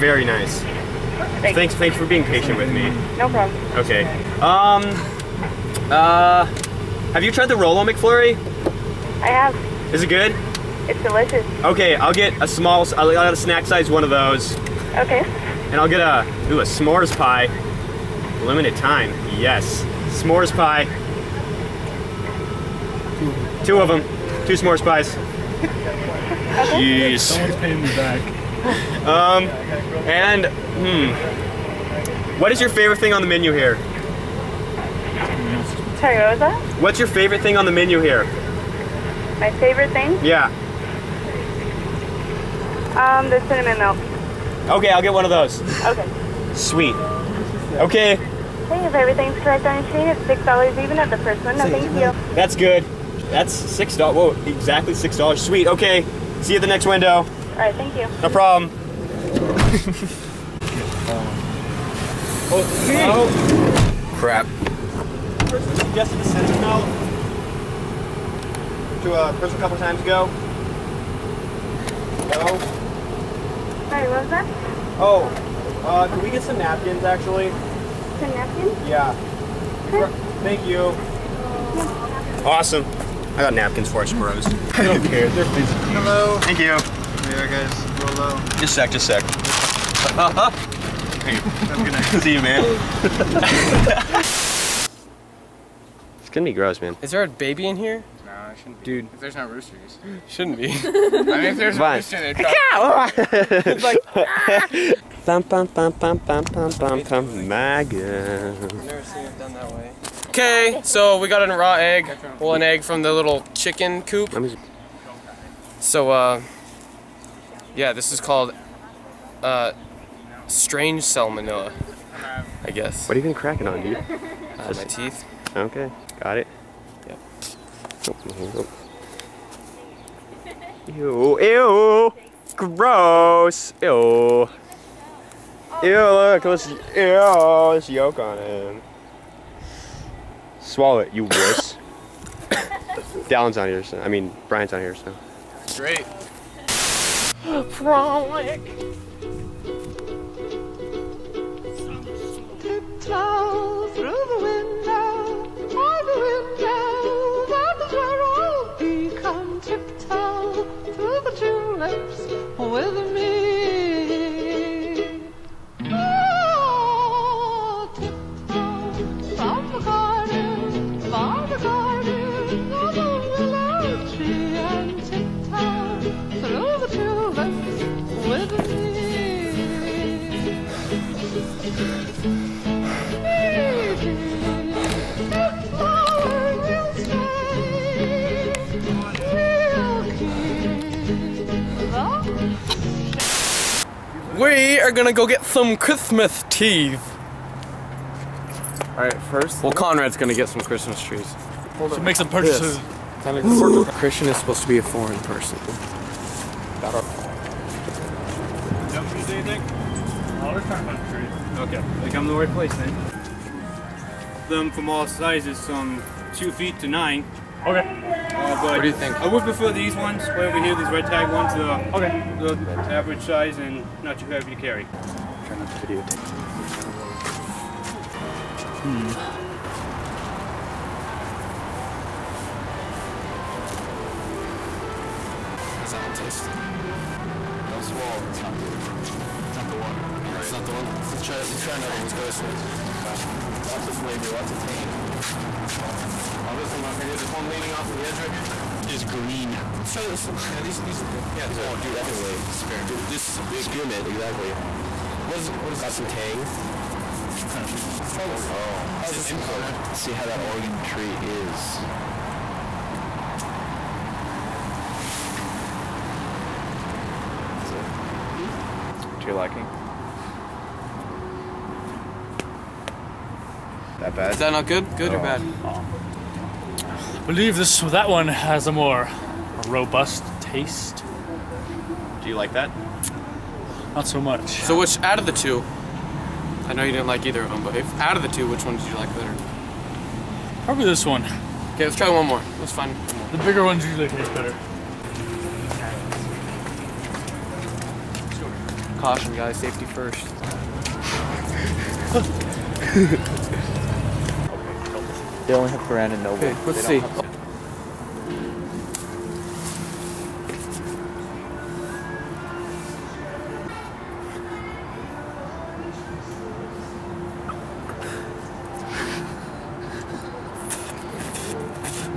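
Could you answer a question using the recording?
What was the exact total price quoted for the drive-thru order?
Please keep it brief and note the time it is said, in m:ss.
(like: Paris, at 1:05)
6 dollars, at 0:50.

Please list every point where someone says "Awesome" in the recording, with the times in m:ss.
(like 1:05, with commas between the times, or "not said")
1:22.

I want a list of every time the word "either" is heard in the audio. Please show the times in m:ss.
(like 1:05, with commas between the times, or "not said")
4:47.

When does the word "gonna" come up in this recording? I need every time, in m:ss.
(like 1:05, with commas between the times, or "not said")
1:36, 3:20.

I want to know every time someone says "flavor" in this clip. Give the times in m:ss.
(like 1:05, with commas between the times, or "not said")
4:03.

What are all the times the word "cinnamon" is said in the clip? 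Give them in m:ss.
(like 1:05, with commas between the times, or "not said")
0:43, 1:06.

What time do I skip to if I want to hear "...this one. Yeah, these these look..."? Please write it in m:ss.
4:10.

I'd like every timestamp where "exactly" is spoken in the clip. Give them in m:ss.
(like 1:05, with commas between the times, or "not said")
0:54, 4:14.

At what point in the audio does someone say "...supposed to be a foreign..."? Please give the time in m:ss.
3:24.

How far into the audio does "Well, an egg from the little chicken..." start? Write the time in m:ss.
1:52.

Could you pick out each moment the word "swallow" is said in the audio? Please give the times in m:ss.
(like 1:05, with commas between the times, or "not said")
2:20, 3:57.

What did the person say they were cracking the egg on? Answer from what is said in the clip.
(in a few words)
My teeth.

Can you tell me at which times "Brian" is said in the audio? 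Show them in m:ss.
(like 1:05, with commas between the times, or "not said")
2:24.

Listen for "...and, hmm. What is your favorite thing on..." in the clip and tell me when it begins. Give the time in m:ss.
0:30.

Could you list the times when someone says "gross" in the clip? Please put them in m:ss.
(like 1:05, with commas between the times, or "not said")
1:36, 2:12.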